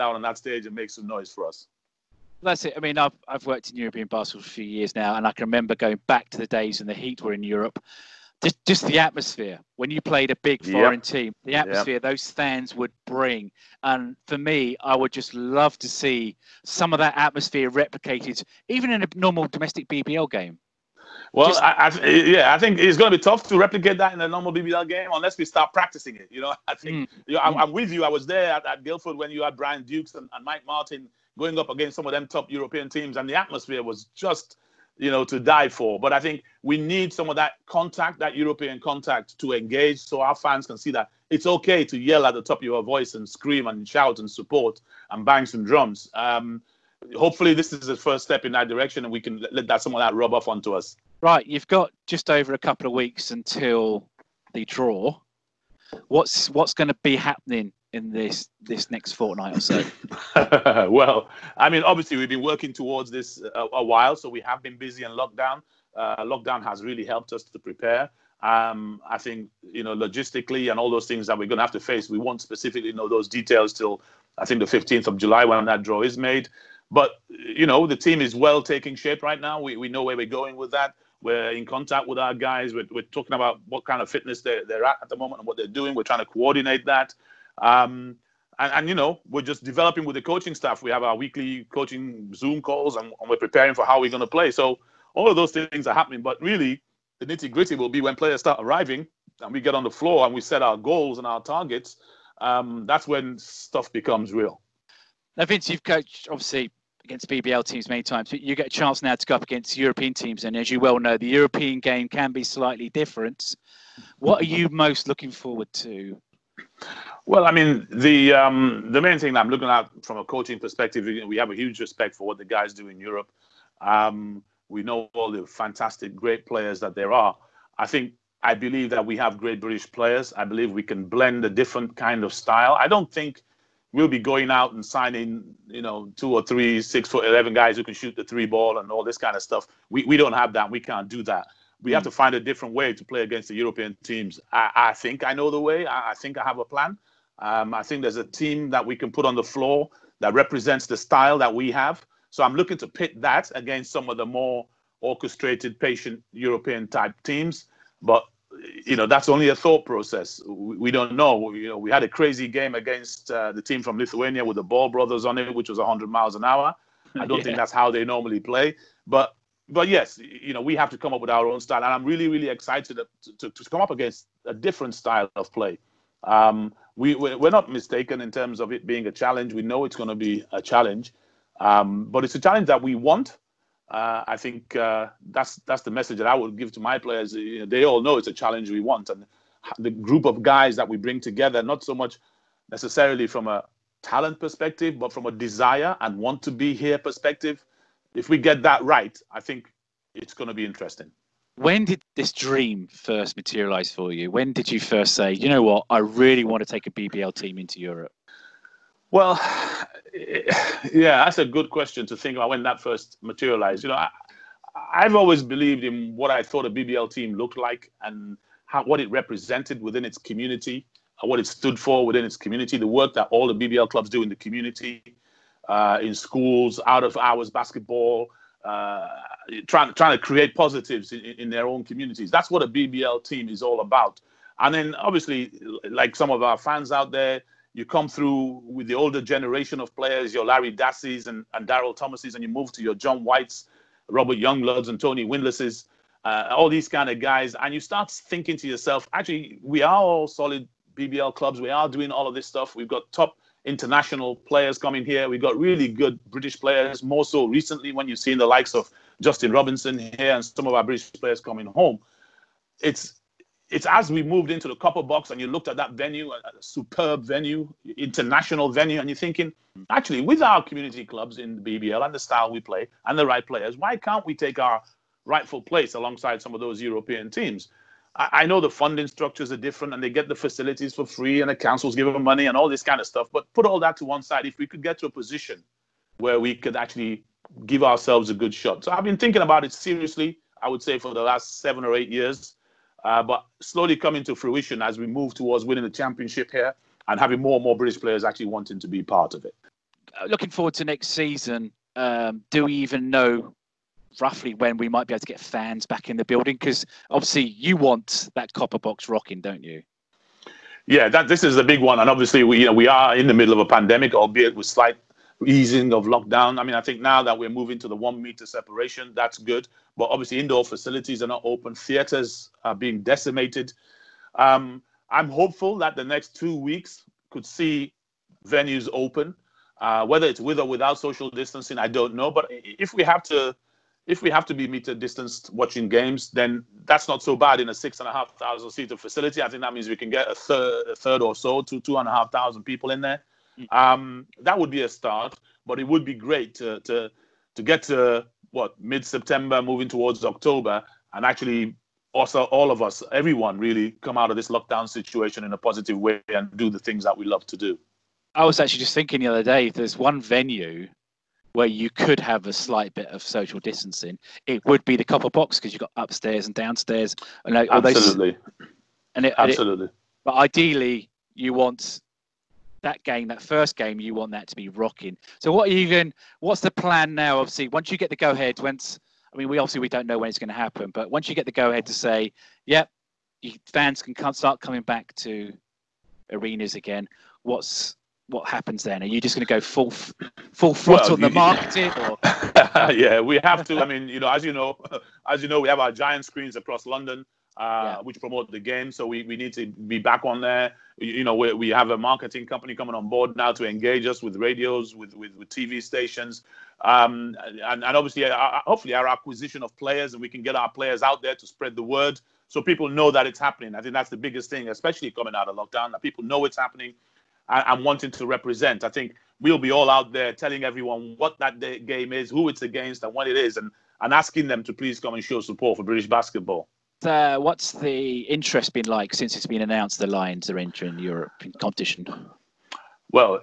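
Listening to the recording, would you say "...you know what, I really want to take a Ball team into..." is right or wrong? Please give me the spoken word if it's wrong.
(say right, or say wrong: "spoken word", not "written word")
wrong: "BBL", not "Ball".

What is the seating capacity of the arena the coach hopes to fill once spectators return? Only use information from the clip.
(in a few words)
6,500.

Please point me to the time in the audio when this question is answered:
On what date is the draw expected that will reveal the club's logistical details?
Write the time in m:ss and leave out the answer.
1:14.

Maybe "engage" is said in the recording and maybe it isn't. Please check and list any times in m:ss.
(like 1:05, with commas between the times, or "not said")
0:39, 6:43.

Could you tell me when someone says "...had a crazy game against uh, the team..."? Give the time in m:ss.
2:41.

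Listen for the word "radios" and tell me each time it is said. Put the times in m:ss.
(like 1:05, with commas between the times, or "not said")
6:44.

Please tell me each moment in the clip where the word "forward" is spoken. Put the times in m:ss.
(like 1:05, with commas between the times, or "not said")
1:55, 5:00.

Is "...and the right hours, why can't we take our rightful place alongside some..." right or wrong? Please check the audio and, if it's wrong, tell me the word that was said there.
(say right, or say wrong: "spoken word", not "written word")
wrong: "players", not "hours".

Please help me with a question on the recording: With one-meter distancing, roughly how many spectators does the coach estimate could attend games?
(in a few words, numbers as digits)
2,500.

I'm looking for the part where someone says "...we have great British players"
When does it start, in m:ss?
2:09.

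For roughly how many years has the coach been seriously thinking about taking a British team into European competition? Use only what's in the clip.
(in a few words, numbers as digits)
7 or 8 years.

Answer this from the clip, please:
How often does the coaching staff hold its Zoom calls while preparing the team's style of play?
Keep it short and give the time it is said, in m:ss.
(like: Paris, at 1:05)
Weekly, at 1:31.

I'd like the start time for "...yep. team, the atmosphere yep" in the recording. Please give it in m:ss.
0:10.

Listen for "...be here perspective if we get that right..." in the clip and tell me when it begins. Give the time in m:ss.
3:16.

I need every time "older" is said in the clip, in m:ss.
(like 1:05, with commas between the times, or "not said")
3:58.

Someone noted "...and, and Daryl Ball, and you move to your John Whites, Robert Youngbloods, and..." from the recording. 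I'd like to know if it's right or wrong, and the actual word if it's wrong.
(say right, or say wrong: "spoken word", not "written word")
wrong: "Thomases", not "Ball".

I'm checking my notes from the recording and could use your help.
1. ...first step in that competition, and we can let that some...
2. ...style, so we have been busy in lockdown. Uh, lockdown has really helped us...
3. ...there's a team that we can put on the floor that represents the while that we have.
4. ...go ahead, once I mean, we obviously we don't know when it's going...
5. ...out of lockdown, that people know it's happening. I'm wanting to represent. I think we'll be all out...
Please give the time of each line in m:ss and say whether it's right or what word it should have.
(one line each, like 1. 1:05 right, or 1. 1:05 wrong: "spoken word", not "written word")
1. 0:47 wrong: "direction", not "competition"
2. 1:03 wrong: "while", not "style"
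3. 2:28 wrong: "style", not "while"
4. 6:18 right
5. 6:55 right.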